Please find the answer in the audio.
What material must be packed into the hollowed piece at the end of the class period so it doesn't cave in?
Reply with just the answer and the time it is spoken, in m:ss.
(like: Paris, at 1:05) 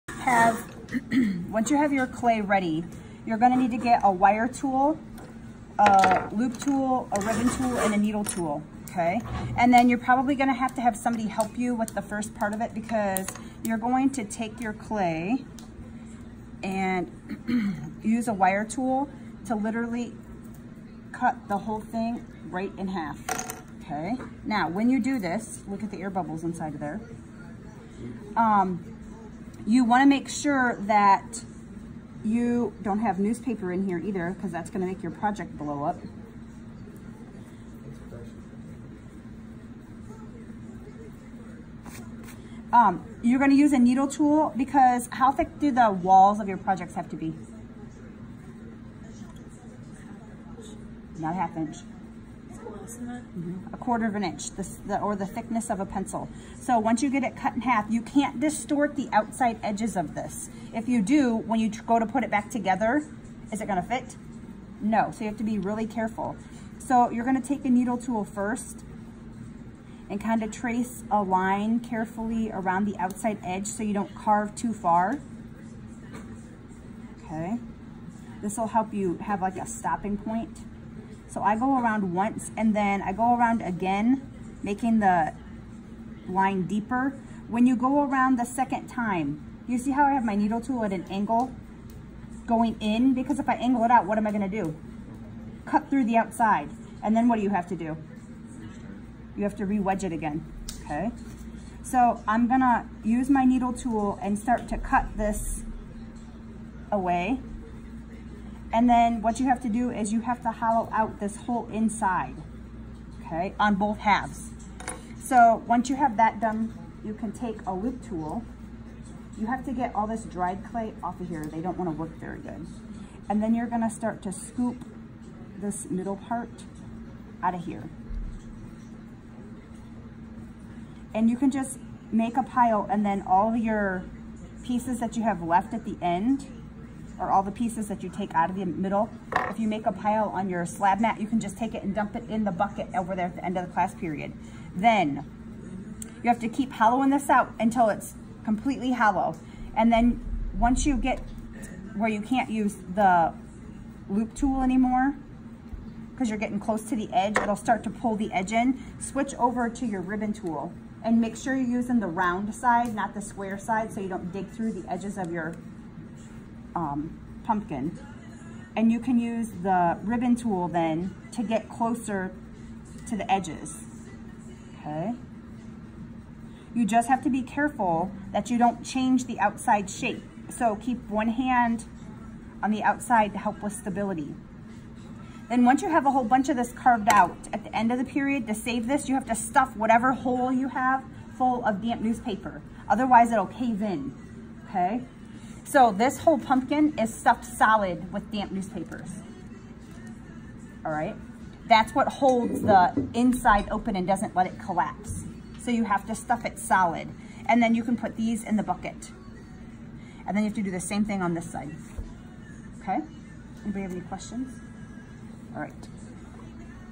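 damp newspaper, at 3:11.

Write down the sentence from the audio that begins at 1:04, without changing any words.
No, so you have to be really careful.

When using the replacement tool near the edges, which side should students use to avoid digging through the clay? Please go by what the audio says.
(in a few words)
the round side.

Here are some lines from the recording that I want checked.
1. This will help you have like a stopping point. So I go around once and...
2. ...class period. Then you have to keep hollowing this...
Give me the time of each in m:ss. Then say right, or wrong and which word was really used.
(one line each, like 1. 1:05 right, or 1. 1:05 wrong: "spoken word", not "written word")
1. 1:18 right
2. 2:23 right.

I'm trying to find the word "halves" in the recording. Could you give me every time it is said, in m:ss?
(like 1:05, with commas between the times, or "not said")
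1:53.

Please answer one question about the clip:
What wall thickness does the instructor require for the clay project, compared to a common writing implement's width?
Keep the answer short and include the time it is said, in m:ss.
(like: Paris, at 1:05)
A quarter of an inch, at 0:53.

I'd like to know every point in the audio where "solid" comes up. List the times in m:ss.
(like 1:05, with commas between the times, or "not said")
3:17, 3:26.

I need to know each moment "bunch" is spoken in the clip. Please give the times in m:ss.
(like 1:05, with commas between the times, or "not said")
3:06.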